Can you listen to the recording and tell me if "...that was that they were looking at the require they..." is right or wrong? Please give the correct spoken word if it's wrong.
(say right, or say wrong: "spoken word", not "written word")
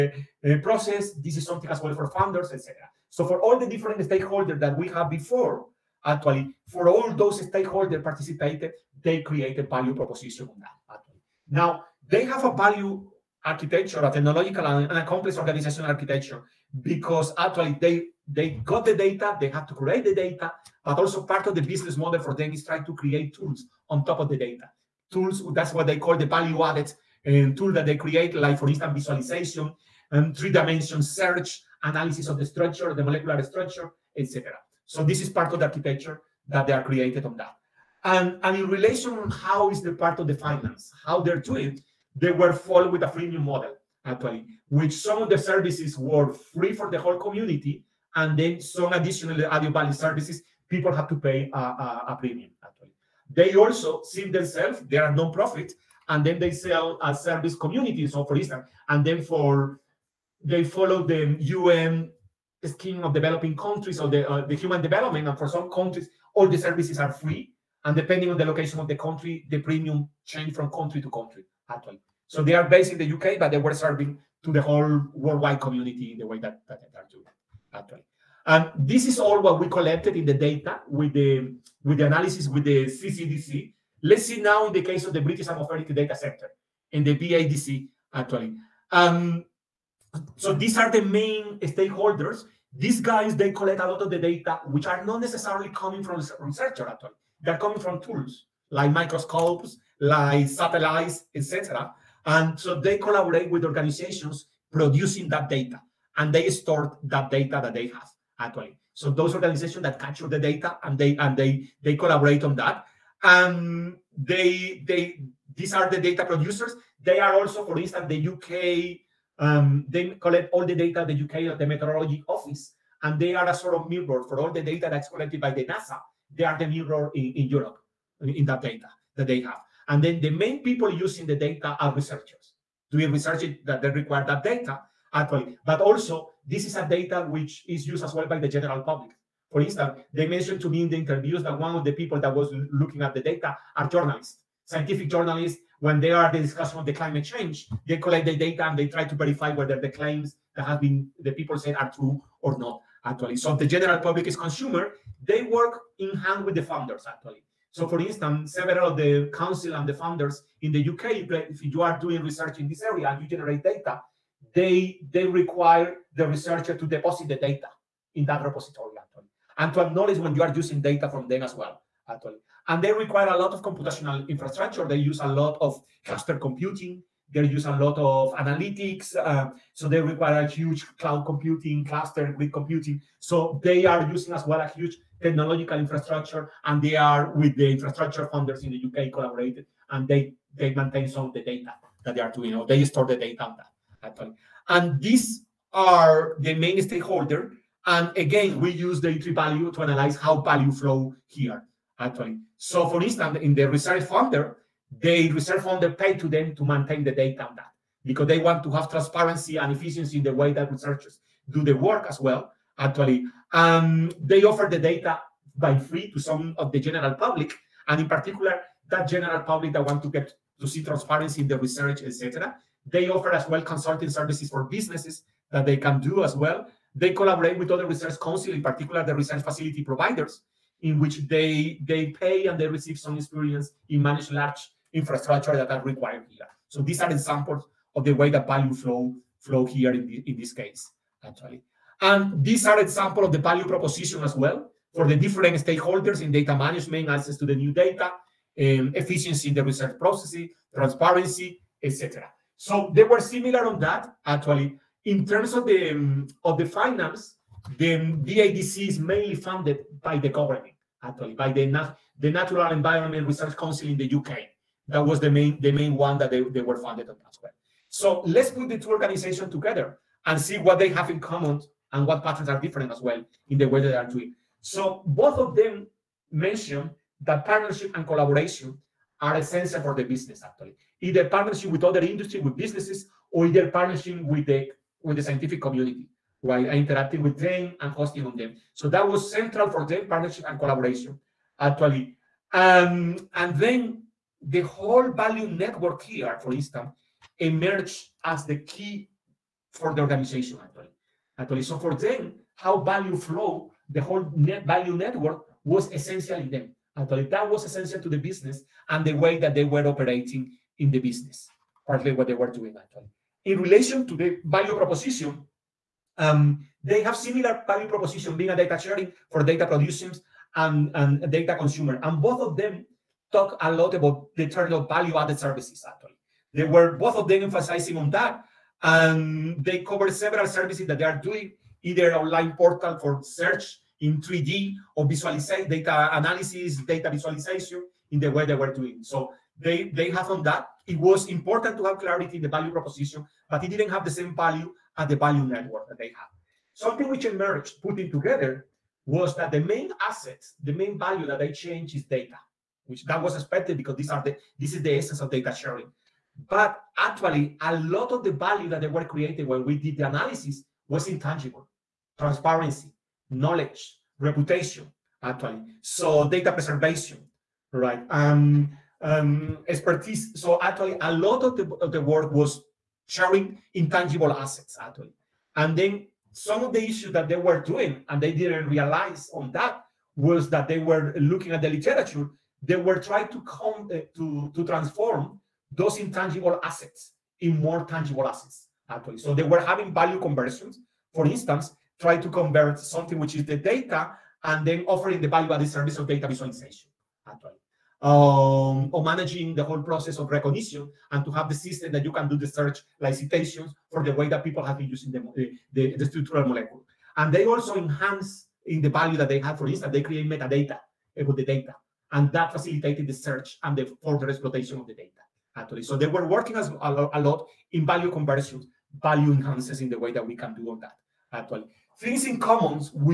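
wrong: "literature", not "require".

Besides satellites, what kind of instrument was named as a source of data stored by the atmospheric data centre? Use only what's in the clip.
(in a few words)
Microscopes.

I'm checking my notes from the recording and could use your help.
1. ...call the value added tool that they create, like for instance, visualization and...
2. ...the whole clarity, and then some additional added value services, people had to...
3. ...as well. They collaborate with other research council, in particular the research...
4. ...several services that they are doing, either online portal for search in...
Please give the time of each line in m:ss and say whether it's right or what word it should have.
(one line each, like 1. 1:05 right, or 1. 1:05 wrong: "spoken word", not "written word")
1. 0:25 right
2. 0:46 wrong: "community", not "clarity"
3. 3:46 right
4. 5:30 right.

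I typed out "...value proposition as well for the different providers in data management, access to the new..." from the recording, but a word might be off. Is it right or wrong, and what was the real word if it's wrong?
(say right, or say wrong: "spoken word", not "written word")
wrong: "stakeholders", not "providers".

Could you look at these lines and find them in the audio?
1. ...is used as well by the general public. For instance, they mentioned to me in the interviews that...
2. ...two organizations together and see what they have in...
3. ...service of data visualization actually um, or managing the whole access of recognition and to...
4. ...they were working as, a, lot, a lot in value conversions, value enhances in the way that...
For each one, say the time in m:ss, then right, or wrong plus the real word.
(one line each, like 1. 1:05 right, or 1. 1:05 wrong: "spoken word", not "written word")
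1. 2:17 right
2. 4:28 right
3. 6:35 wrong: "process", not "access"
4. 6:55 right.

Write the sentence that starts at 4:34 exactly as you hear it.
So both of them mention that partnership and collaboration are essential for the business actually.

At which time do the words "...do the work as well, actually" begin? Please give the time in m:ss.
3:31.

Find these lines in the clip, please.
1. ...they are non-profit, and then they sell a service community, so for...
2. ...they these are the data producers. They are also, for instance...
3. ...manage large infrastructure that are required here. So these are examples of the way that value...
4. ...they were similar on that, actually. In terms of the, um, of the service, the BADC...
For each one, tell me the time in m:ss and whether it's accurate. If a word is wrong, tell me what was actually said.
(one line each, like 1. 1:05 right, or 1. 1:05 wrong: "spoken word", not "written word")
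1. 0:54 right
2. 1:54 right
3. 3:54 right
4. 4:12 wrong: "finance", not "service".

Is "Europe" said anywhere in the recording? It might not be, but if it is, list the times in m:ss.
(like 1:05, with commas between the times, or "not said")
2:07.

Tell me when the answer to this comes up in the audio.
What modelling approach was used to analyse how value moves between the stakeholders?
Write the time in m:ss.
3:19.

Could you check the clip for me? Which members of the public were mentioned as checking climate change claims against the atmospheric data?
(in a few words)
Scientific journalists.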